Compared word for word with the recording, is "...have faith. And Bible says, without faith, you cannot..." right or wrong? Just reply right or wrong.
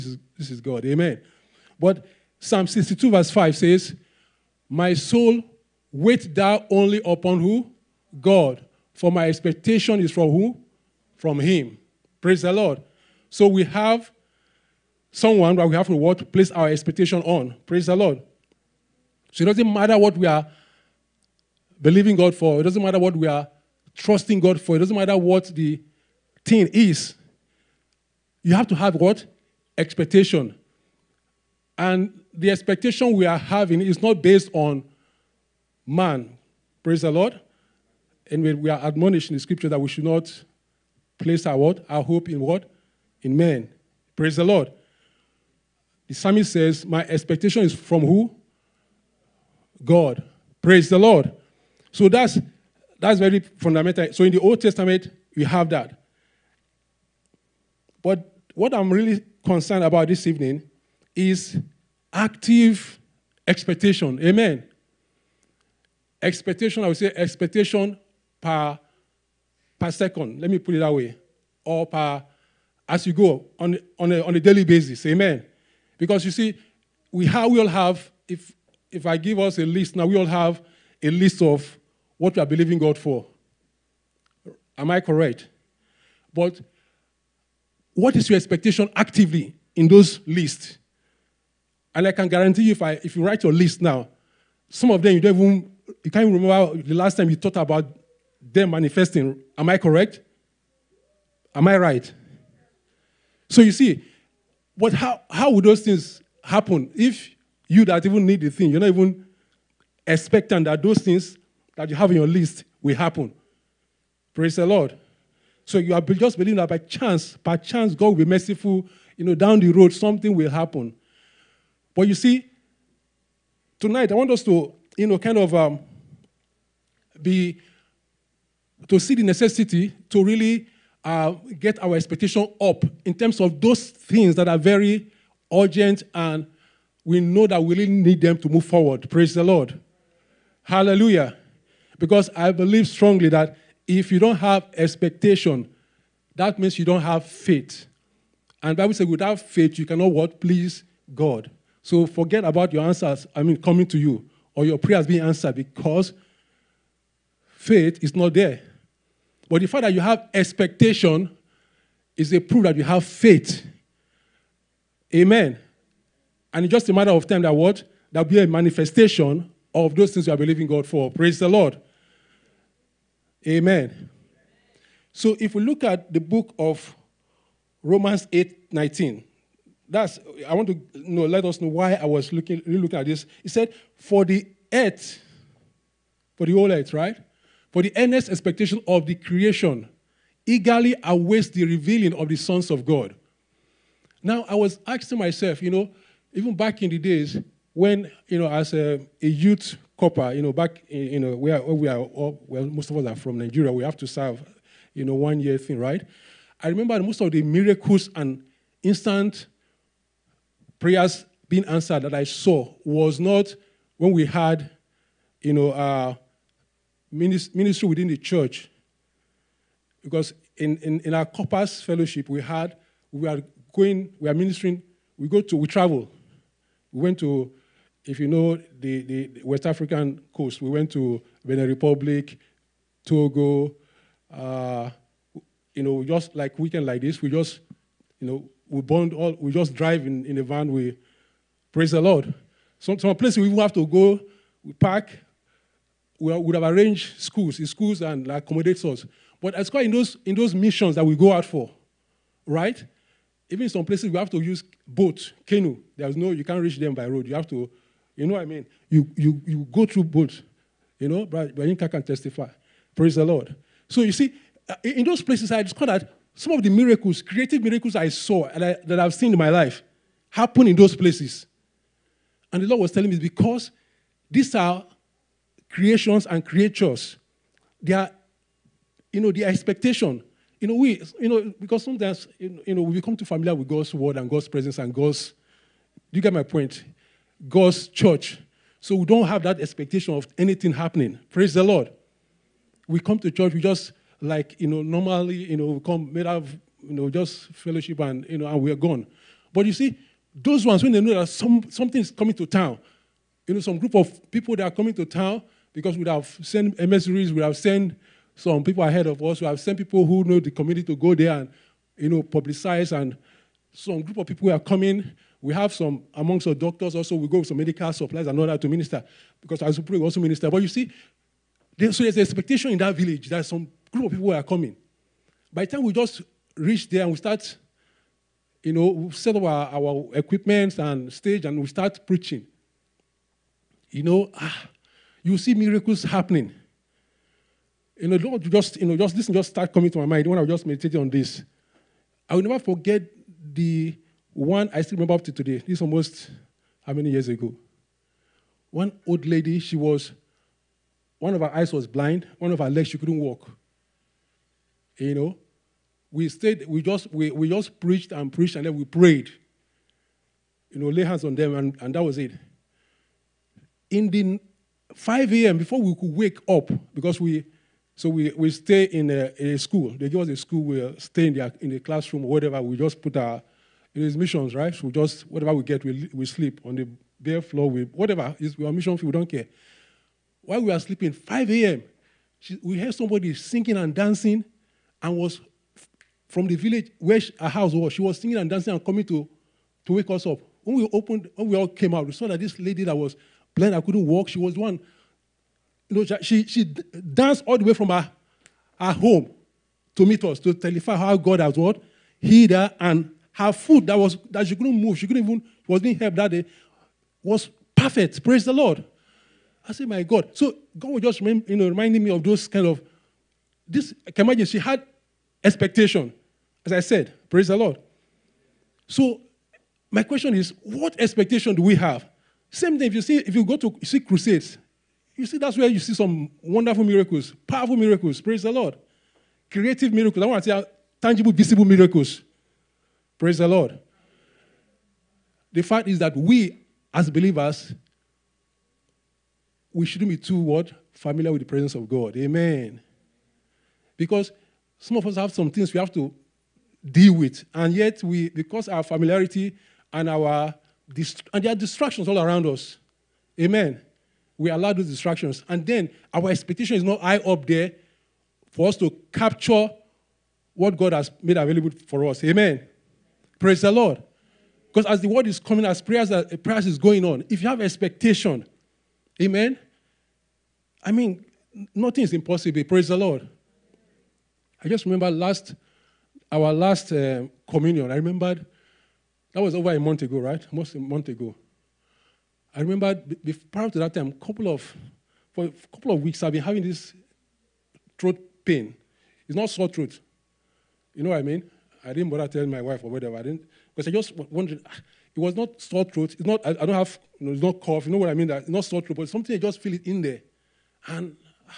right.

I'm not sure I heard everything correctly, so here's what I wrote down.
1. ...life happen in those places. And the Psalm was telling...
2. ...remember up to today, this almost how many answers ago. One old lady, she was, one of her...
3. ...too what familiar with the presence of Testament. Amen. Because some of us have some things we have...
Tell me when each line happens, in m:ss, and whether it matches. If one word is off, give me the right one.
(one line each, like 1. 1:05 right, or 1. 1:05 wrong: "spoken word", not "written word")
1. 4:29 wrong: "Lord", not "Psalm"
2. 5:44 wrong: "years", not "answers"
3. 7:20 wrong: "God", not "Testament".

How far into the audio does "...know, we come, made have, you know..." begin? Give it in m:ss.
4:55.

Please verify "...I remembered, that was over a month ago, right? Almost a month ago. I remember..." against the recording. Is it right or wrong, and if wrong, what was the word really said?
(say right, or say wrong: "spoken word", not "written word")
right.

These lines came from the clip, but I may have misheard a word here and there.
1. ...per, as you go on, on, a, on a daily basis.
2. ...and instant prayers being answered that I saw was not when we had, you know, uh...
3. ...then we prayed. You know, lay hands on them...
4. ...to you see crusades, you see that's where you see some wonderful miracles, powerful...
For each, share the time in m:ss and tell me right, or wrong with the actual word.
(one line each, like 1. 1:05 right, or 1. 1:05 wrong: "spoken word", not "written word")
1. 1:11 right
2. 3:28 right
3. 5:58 right
4. 7:03 right.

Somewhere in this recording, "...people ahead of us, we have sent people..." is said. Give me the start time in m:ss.
5:08.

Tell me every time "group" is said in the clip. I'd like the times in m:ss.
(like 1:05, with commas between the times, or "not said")
5:03, 5:14, 5:23.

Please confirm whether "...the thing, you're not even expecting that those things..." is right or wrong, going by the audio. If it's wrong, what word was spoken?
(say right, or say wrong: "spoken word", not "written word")
right.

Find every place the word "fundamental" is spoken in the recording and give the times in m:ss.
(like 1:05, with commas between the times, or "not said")
0:53.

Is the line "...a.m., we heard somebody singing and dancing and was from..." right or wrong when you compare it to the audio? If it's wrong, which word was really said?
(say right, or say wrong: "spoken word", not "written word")
right.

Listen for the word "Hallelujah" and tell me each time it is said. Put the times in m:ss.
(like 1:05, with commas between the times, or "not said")
2:20.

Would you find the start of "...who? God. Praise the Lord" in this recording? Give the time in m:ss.
0:48.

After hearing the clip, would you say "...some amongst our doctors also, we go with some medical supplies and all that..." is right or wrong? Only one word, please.
right.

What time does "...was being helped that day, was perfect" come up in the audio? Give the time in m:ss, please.
6:45.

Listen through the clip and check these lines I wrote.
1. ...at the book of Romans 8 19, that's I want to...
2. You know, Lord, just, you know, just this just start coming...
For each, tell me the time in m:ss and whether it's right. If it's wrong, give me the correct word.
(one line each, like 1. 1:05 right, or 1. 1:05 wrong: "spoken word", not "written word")
1. 2:55 right
2. 5:37 right.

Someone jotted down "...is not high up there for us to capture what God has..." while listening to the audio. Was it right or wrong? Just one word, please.
right.